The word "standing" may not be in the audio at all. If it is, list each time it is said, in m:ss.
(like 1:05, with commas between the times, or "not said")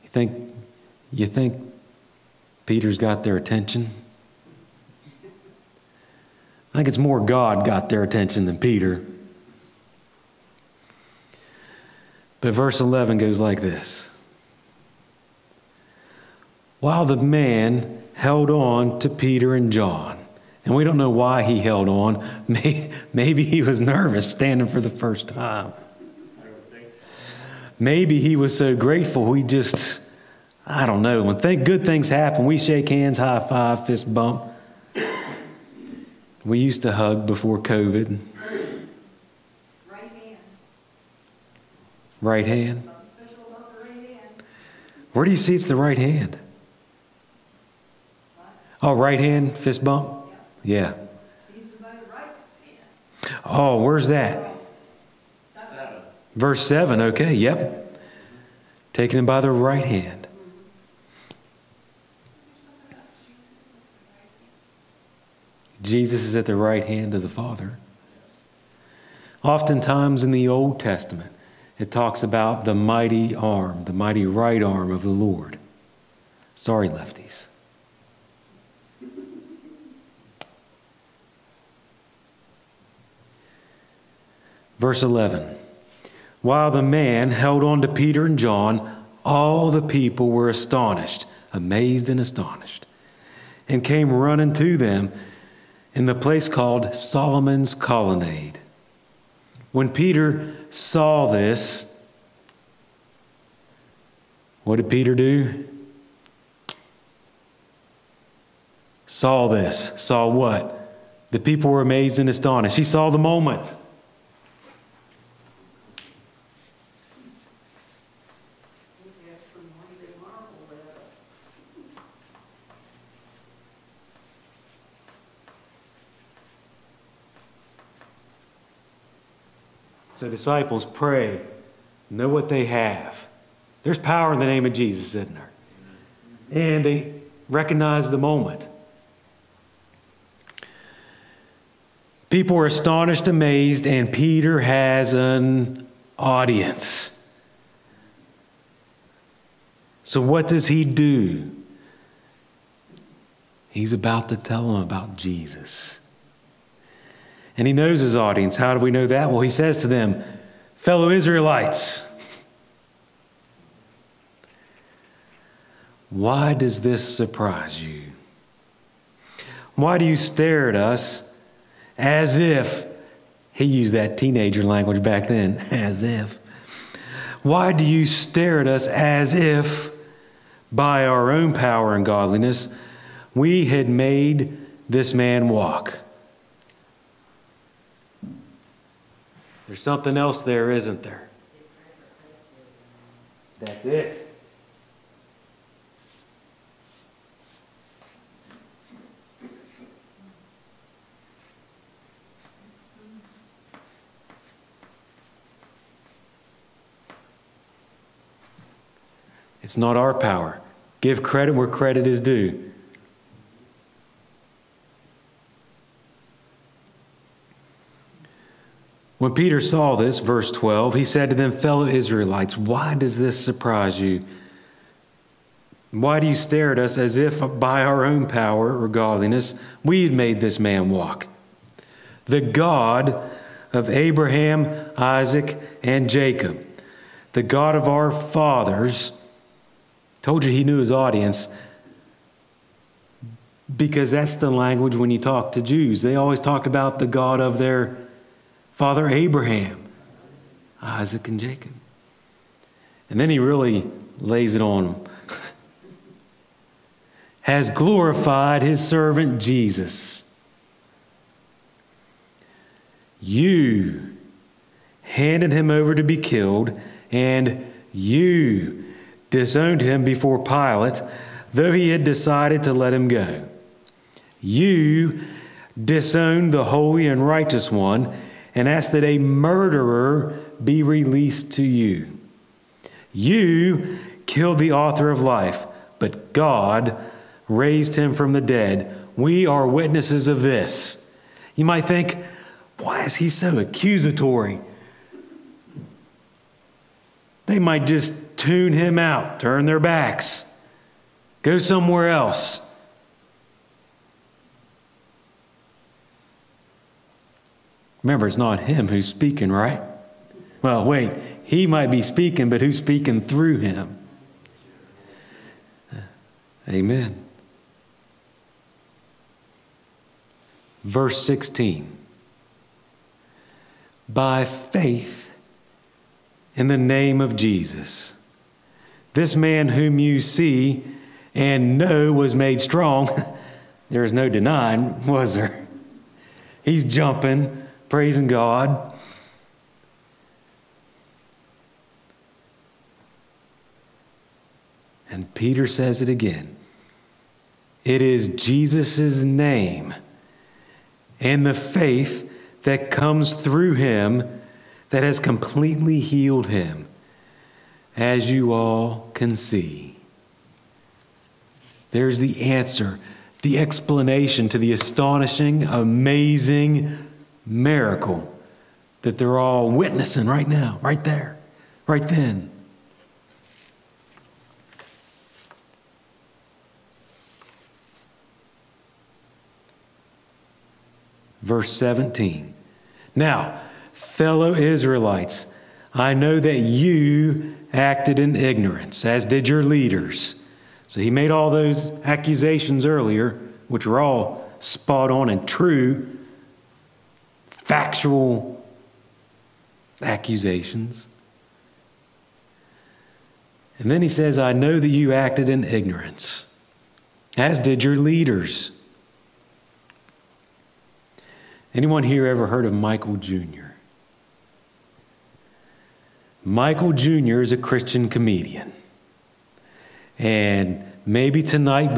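0:24.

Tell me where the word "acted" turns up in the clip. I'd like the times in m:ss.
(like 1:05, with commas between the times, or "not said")
6:27, 6:45.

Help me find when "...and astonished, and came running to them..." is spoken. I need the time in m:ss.
1:32.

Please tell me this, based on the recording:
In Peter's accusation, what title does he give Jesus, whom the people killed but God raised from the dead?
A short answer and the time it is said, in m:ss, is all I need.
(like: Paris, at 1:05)
the author of life, at 4:44.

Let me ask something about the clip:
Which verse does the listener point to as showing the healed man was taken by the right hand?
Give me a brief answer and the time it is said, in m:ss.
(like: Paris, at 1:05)
Verse 7, at 0:56.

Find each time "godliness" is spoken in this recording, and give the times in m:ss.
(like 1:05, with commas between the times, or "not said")
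3:02, 3:48.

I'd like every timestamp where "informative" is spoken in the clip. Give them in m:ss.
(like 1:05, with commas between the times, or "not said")
not said.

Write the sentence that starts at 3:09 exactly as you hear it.
There's something else there, isn't there?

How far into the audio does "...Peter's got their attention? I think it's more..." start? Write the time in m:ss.
0:02.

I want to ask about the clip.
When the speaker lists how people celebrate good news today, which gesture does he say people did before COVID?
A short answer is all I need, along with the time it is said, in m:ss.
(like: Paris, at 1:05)
hug, at 0:36.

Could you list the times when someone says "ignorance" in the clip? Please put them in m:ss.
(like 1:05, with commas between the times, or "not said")
6:28, 6:45.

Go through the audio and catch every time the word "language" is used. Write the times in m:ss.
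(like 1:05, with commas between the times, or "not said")
2:54, 4:04.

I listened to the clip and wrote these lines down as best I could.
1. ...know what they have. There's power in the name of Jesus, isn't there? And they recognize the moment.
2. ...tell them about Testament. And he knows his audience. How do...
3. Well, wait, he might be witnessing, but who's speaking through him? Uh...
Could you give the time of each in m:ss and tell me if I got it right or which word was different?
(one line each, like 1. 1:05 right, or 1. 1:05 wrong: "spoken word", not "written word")
1. 2:12 right
2. 2:34 wrong: "Jesus", not "Testament"
3. 5:10 wrong: "speaking", not "witnessing".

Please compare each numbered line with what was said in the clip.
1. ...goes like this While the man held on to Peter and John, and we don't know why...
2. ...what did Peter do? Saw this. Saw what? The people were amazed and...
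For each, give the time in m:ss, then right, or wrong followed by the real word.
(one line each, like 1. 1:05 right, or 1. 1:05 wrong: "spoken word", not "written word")
1. 0:13 right
2. 1:44 right.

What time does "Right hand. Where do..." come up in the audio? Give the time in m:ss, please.
0:42.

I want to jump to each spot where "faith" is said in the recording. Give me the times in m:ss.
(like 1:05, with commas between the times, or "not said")
5:24, 5:51.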